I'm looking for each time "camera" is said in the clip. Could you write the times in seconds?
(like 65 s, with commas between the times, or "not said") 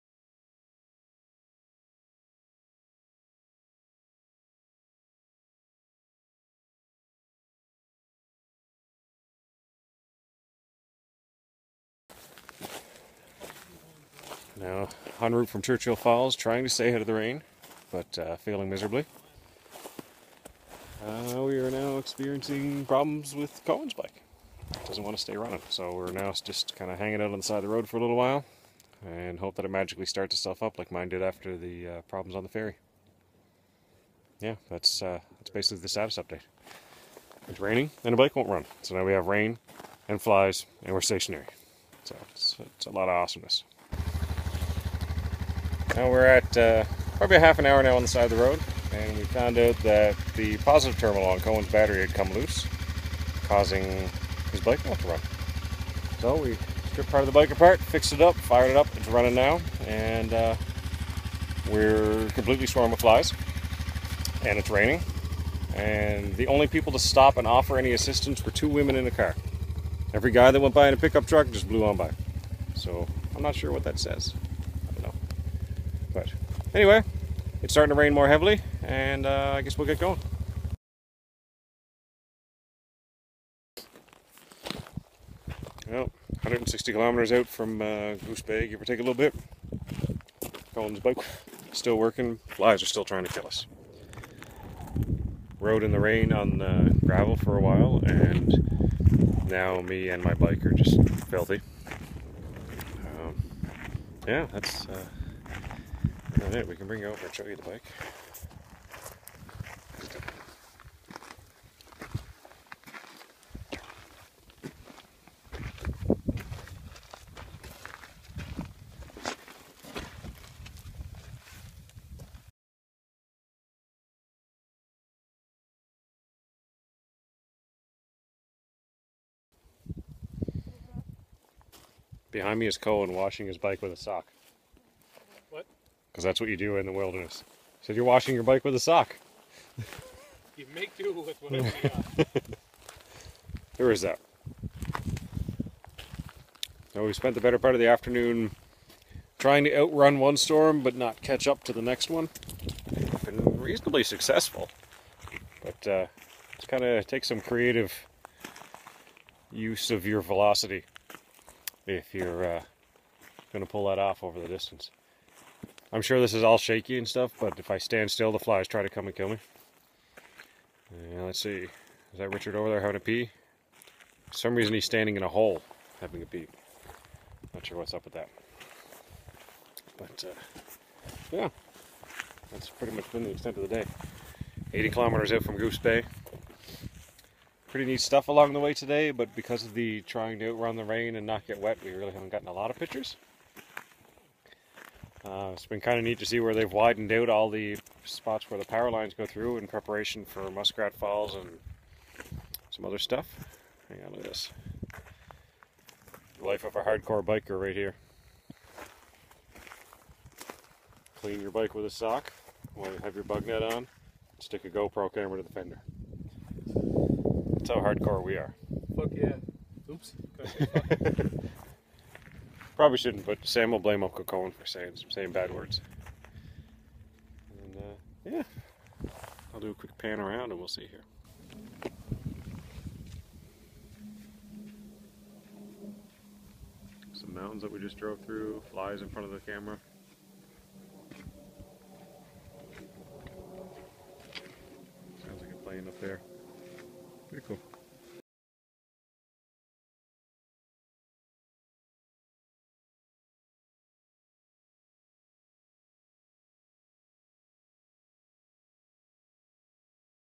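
215 s, 239 s.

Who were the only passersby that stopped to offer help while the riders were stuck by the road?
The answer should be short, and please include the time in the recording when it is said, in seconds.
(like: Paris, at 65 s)
two women in a car, at 68 s.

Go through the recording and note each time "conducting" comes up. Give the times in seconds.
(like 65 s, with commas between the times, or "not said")
not said.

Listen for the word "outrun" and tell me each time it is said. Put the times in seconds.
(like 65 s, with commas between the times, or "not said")
149 s, 190 s.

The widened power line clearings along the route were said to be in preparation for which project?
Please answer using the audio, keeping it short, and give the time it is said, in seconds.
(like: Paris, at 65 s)
Muskrat Falls, at 200 s.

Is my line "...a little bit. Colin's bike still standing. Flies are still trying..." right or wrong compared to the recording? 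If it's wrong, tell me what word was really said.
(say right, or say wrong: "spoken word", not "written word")
wrong: "working", not "standing".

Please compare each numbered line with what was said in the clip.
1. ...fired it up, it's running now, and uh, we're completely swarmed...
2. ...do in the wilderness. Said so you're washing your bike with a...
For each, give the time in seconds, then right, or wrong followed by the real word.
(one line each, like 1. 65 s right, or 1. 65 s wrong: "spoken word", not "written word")
1. 58 s right
2. 136 s right.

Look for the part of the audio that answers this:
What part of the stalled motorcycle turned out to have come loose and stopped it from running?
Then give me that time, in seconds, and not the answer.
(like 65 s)
50 s.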